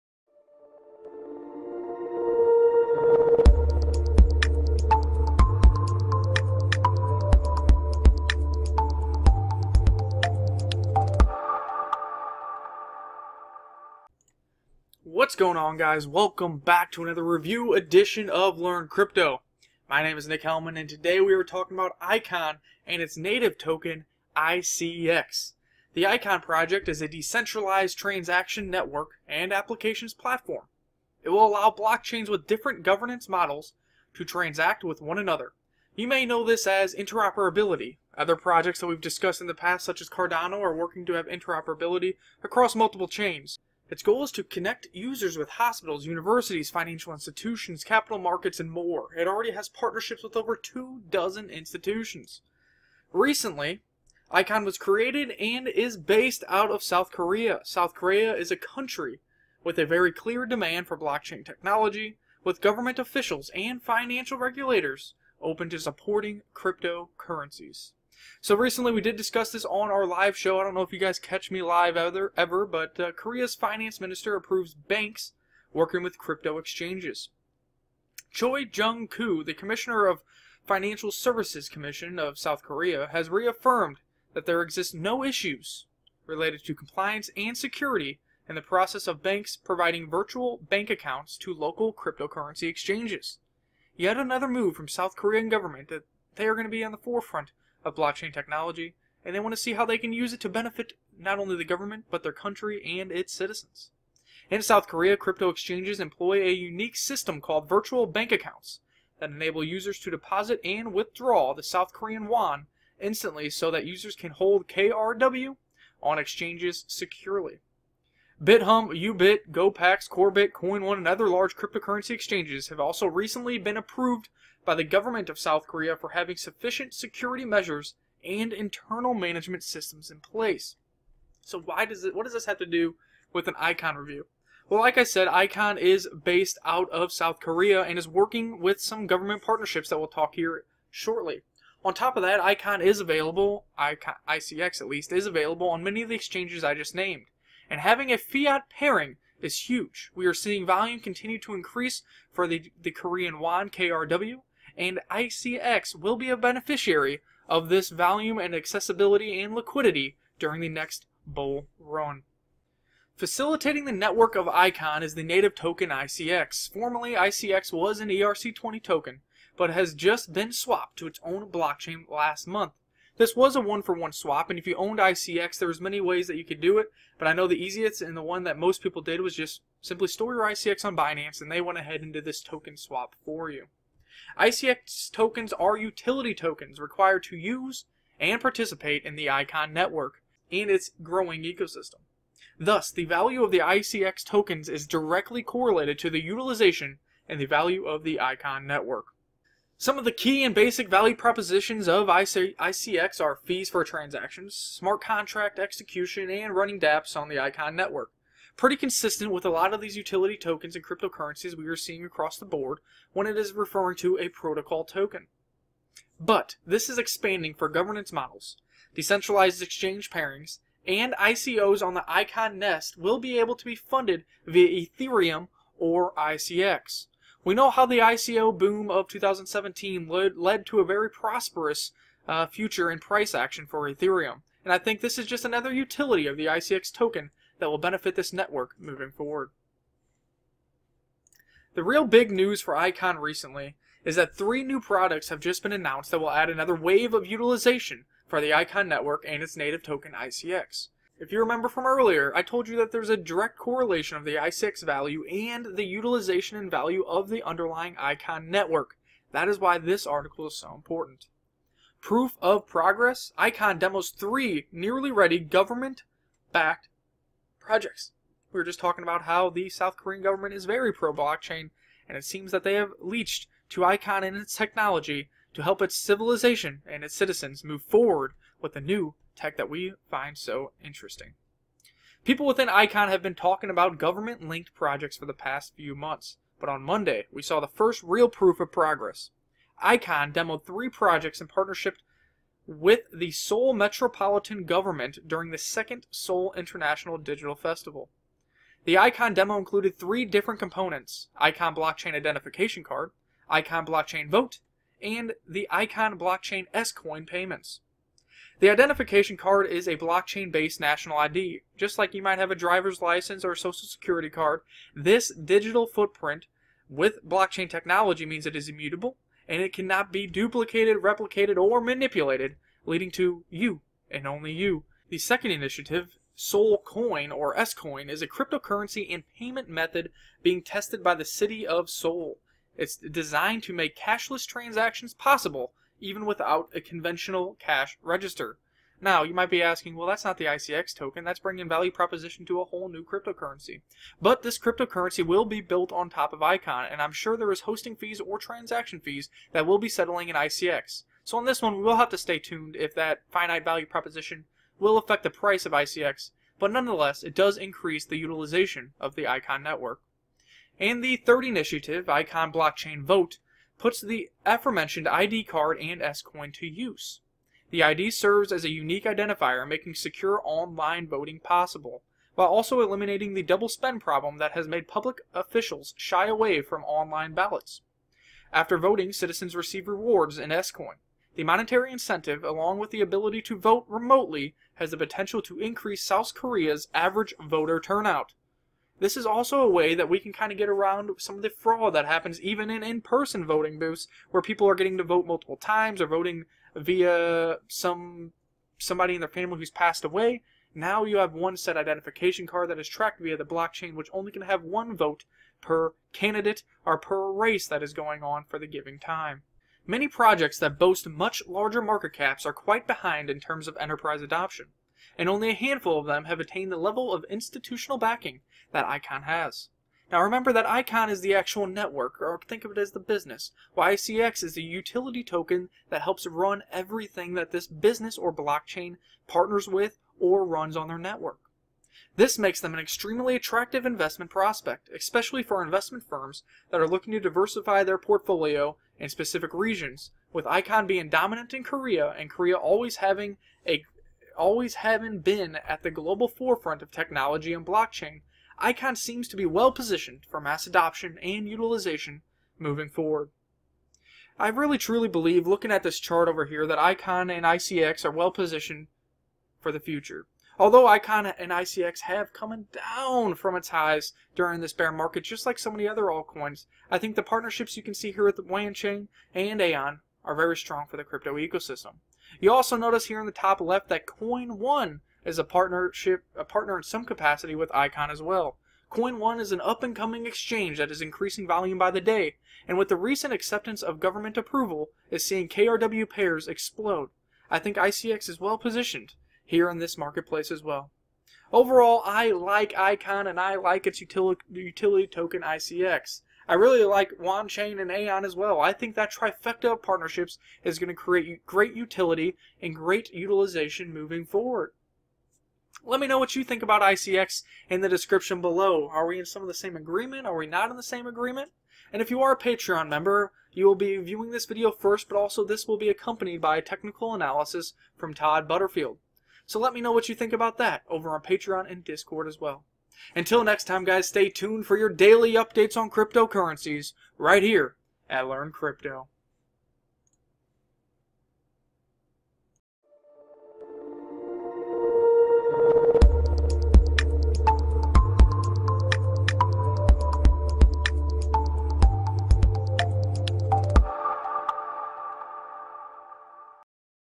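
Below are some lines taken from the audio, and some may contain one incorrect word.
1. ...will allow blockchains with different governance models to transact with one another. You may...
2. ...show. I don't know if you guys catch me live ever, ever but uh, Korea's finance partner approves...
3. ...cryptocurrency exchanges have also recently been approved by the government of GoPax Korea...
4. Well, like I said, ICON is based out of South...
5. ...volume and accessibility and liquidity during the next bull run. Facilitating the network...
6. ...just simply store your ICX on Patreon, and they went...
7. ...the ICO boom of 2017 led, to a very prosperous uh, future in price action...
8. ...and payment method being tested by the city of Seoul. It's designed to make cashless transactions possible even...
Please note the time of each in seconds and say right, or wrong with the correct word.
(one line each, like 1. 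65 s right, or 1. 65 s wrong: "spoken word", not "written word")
1. 31 s right
2. 70 s wrong: "minister", not "partner"
3. 121 s wrong: "South", not "GoPax"
4. 134 s right
5. 157 s right
6. 179 s wrong: "Binance", not "Patreon"
7. 227 s right
8. 329 s right.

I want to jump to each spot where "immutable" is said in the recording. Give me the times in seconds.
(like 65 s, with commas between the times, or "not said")
318 s.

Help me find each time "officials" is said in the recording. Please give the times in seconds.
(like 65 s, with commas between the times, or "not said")
62 s, 375 s.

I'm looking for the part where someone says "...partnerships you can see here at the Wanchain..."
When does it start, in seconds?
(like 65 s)
467 s.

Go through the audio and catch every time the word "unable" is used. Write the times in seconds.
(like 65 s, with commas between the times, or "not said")
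not said.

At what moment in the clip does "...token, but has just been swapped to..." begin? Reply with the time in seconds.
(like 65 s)
168 s.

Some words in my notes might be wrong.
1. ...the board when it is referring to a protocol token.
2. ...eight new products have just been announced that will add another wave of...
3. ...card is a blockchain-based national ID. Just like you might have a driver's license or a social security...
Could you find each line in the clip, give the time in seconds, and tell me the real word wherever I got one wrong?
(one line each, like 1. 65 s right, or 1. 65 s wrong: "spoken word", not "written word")
1. 212 s right
2. 244 s wrong: "three", not "eight"
3. 309 s right.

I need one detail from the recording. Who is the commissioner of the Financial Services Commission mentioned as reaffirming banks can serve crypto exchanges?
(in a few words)
Choi Jung-koo.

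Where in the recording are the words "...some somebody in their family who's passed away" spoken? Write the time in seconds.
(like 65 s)
397 s.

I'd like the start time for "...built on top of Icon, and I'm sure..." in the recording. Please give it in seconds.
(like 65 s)
345 s.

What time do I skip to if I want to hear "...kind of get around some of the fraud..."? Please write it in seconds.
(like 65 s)
390 s.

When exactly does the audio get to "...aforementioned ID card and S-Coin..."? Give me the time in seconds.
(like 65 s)
364 s.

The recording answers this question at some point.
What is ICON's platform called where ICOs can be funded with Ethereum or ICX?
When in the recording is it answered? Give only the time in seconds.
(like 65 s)
222 s.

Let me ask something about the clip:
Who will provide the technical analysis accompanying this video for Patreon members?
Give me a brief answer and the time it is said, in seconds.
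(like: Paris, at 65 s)
Todd Butterfield, at 518 s.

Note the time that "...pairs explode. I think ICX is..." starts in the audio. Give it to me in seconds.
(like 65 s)
486 s.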